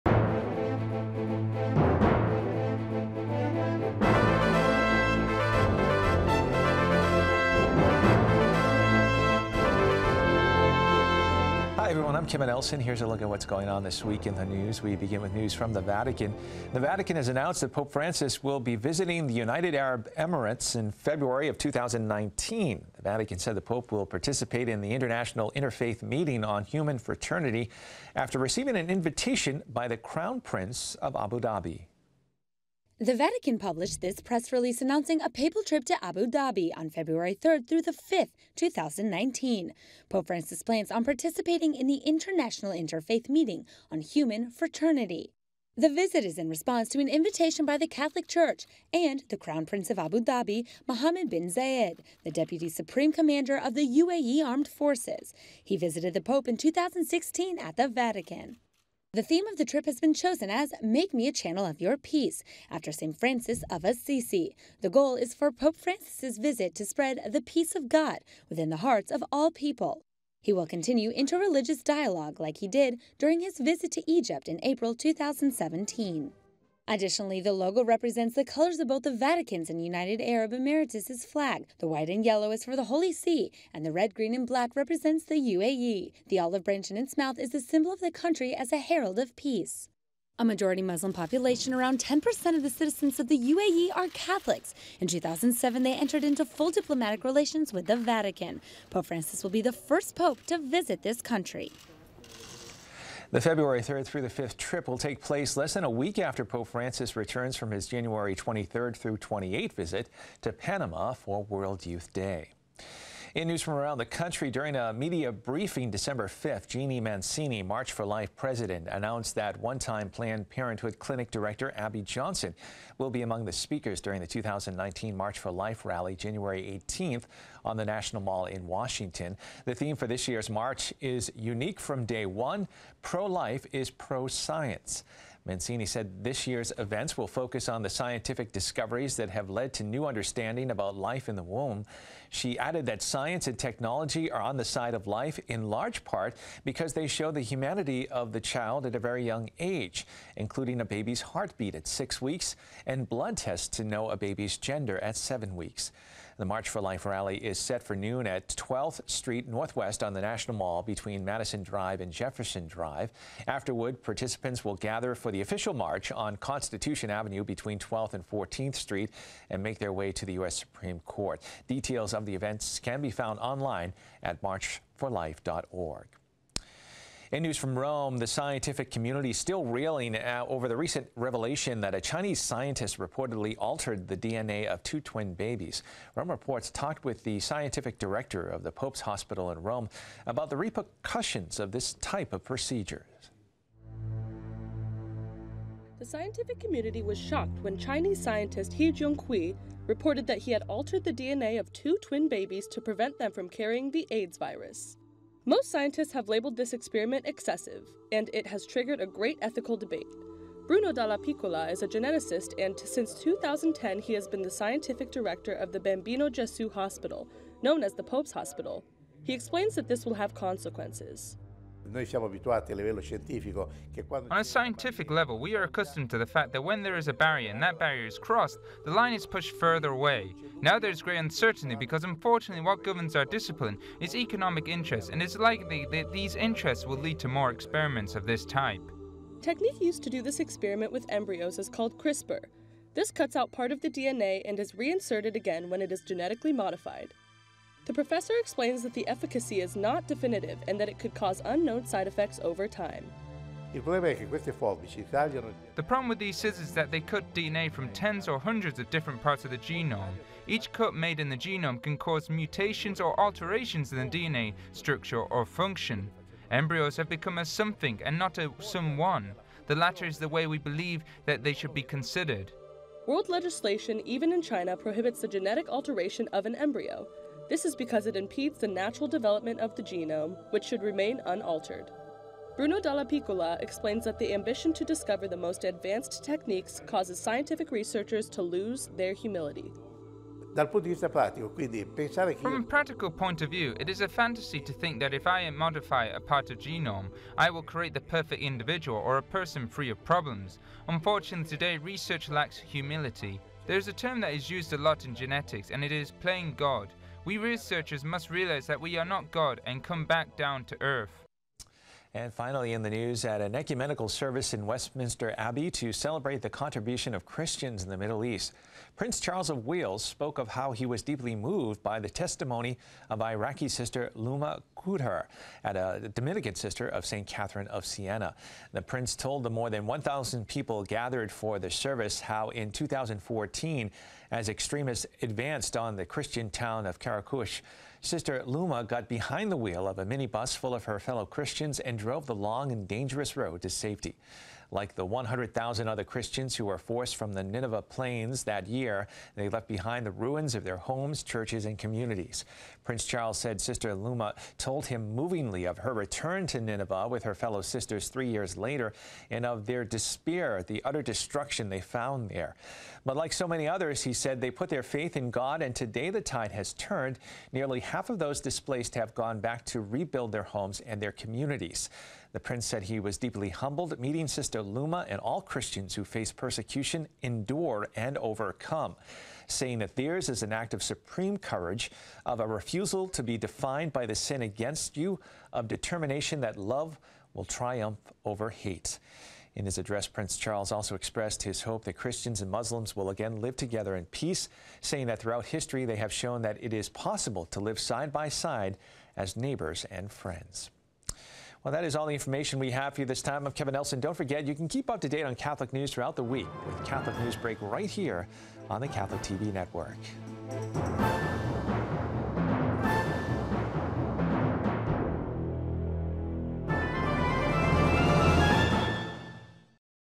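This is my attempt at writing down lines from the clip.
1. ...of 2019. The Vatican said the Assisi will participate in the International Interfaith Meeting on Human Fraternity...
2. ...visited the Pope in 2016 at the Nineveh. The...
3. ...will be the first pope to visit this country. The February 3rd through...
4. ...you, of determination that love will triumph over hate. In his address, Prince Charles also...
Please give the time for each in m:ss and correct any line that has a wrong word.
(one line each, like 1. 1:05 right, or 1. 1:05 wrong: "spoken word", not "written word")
1. 0:21 wrong: "Pope", not "Assisi"
2. 0:55 wrong: "Vatican", not "Nineveh"
3. 1:39 right
4. 6:24 right.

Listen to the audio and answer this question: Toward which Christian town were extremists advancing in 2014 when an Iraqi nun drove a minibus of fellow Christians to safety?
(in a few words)
Karakush.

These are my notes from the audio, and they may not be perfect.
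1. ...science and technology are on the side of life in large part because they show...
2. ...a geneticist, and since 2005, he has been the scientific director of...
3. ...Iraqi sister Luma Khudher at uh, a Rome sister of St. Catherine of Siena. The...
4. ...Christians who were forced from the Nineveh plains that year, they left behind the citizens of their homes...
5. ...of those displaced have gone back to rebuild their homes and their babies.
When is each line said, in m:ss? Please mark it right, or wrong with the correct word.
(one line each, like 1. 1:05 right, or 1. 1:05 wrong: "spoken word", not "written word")
1. 2:23 right
2. 3:31 wrong: "2010", not "2005"
3. 5:23 wrong: "Dominican", not "Rome"
4. 5:46 wrong: "ruins", not "citizens"
5. 6:08 wrong: "communities", not "babies".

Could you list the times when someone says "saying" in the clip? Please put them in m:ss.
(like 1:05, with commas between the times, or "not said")
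6:19, 6:34.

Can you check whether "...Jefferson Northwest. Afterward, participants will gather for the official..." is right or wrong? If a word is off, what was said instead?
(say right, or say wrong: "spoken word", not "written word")
wrong: "Drive", not "Northwest".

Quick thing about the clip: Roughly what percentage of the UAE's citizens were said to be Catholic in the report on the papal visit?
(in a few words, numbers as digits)
10%.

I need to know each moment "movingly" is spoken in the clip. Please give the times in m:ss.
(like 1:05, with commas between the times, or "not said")
5:55.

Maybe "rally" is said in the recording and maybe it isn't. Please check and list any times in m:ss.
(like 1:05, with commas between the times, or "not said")
2:05, 2:37.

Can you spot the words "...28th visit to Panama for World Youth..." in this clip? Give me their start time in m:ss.
1:49.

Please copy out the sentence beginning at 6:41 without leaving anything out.
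Well, that is all the information we have for you this time.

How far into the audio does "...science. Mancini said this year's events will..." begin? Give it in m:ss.
2:14.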